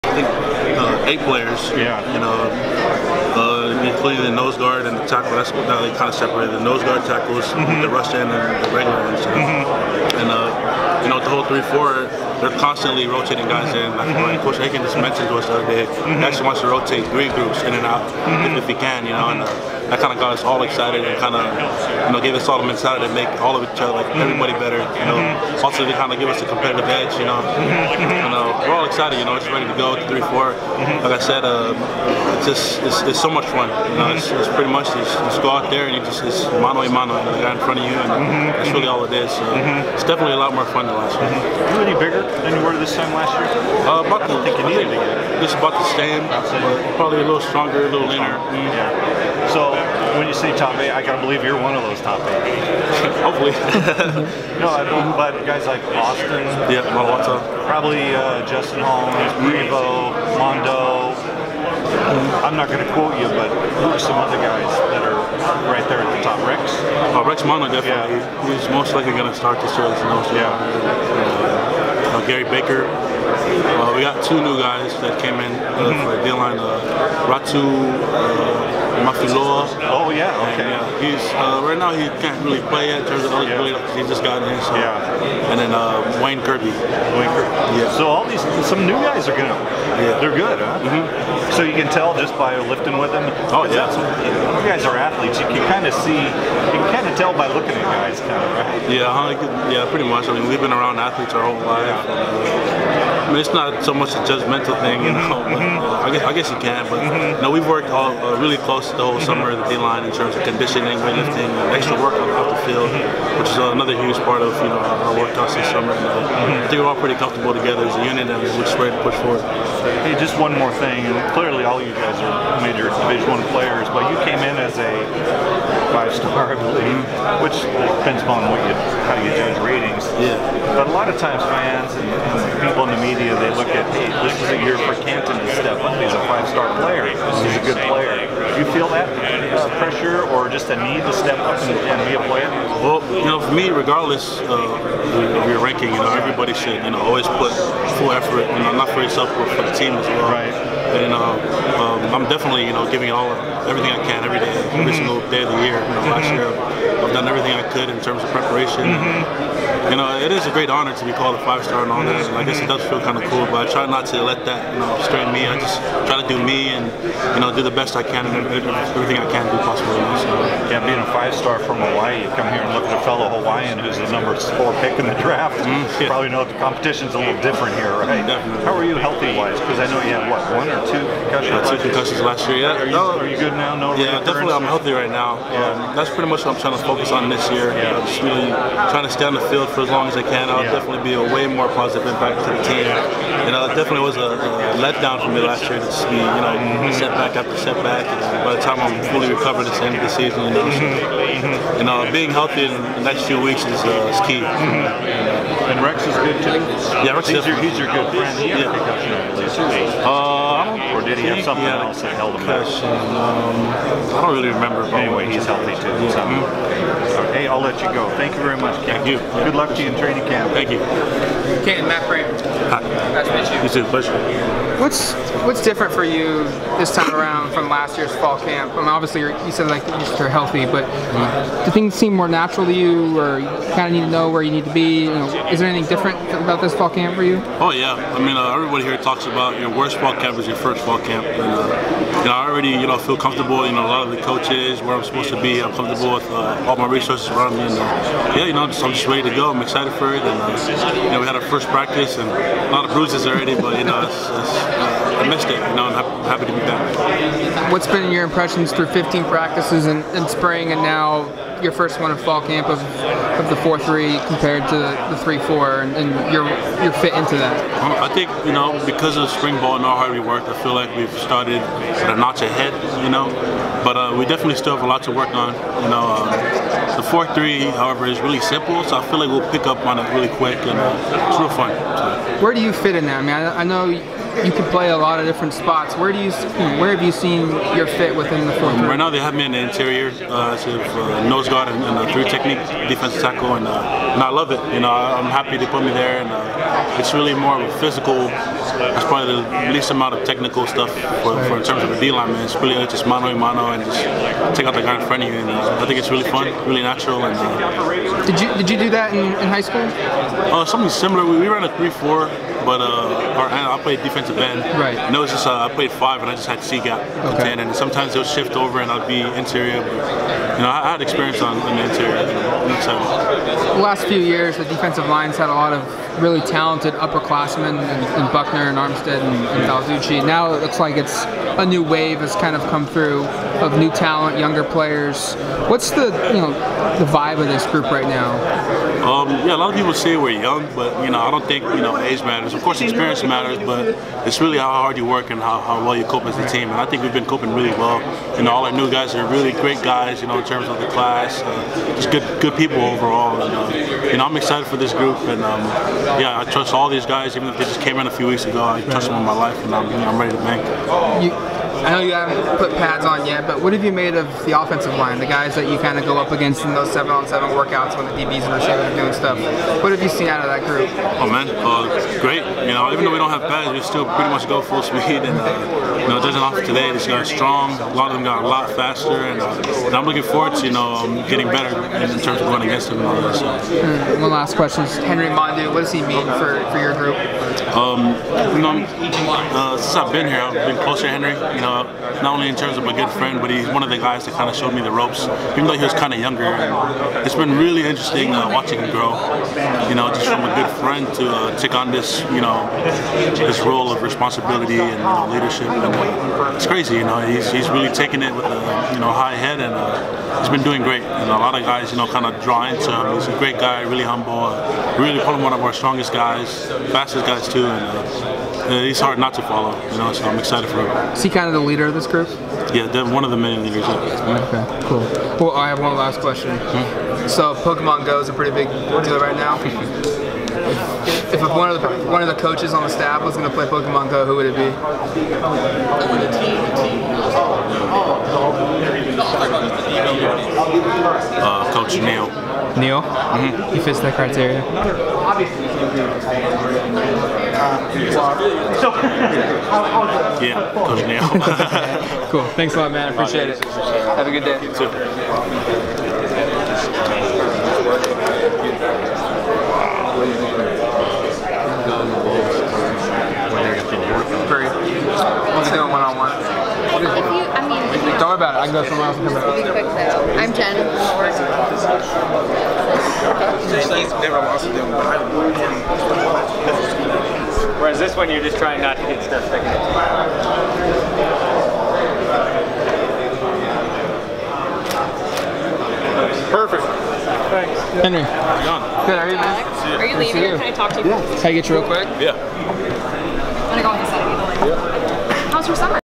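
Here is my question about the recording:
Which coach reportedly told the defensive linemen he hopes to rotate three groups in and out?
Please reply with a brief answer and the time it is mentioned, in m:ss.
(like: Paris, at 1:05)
Coach Aiken, at 0:14.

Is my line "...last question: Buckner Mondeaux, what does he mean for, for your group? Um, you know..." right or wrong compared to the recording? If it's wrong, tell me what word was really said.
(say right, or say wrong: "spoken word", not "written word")
wrong: "Henry", not "Buckner".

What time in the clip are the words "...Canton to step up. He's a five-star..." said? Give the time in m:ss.
2:15.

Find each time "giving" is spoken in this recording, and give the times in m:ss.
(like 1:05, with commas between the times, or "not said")
2:32.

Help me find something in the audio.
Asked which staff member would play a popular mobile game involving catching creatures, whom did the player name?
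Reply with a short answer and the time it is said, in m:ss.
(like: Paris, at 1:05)
Coach Neil, at 7:21.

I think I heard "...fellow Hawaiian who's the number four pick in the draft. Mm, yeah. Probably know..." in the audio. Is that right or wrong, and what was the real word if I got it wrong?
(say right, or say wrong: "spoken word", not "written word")
right.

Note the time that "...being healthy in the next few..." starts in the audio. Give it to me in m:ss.
3:22.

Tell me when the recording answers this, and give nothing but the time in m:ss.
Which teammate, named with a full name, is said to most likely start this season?
1:07.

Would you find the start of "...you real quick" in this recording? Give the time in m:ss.
8:11.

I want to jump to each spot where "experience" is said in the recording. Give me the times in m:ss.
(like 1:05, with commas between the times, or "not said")
5:21, 5:42.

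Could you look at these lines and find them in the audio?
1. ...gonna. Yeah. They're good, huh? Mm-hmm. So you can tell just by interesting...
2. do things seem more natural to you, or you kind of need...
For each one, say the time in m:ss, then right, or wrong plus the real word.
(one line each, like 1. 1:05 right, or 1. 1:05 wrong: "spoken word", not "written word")
1. 1:29 wrong: "lifting", not "interesting"
2. 3:51 right.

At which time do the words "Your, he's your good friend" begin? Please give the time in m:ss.
3:27.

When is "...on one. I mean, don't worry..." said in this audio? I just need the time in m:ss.
7:46.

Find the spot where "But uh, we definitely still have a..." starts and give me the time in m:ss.
4:33.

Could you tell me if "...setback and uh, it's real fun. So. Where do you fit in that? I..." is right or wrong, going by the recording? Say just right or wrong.
wrong.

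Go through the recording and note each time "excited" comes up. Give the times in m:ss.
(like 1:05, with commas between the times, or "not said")
0:20, 0:28, 4:09, 5:54, 7:00.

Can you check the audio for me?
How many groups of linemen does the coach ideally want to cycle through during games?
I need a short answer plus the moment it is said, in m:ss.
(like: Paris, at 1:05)
3, at 0:17.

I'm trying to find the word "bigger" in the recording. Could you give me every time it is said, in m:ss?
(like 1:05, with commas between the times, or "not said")
0:41.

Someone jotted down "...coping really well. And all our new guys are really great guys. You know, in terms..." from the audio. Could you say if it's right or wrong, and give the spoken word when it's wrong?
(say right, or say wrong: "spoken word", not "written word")
right.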